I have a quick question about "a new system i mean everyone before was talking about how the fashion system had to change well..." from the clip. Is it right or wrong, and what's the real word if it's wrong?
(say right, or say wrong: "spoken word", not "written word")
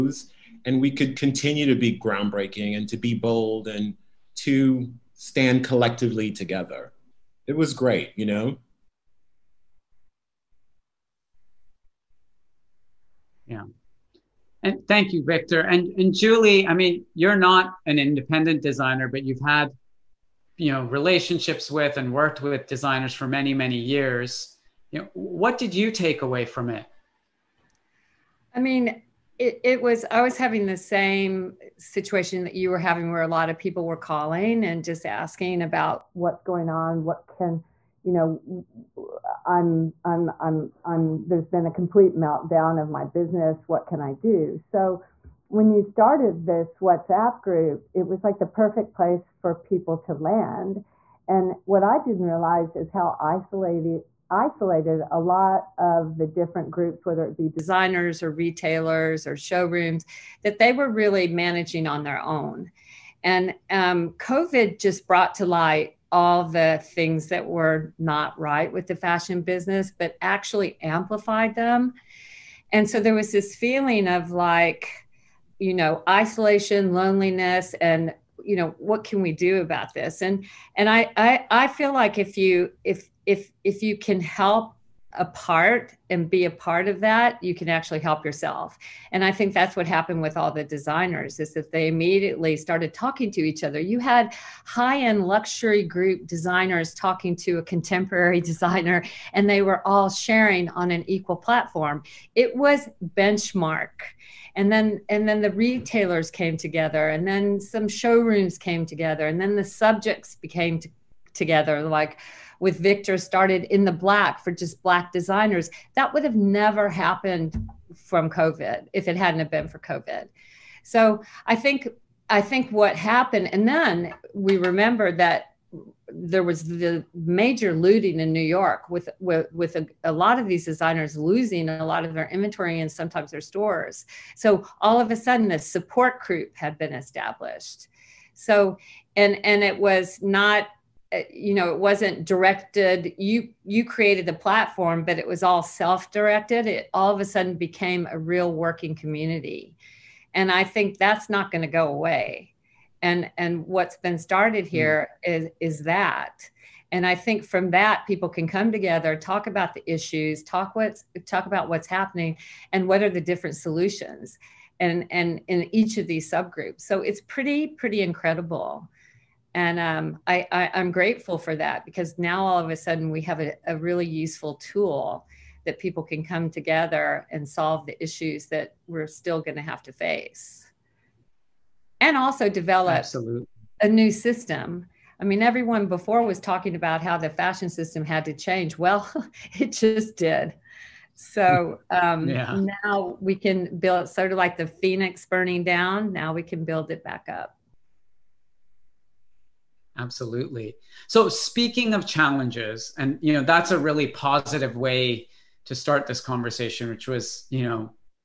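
right.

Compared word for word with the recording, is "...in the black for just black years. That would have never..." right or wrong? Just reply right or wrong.
wrong.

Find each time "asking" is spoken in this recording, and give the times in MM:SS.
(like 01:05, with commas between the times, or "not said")
00:35.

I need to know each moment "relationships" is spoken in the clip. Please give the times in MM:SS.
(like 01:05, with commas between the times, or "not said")
00:20.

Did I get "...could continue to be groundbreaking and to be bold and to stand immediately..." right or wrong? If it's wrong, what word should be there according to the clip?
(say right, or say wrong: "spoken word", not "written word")
wrong: "collectively", not "immediately".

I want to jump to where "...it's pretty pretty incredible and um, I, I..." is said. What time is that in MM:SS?
02:47.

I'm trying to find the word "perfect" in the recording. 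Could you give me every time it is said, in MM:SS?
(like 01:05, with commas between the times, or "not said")
00:48.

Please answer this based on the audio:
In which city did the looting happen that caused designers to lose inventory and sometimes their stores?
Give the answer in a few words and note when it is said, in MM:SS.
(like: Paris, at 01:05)
New York, at 02:08.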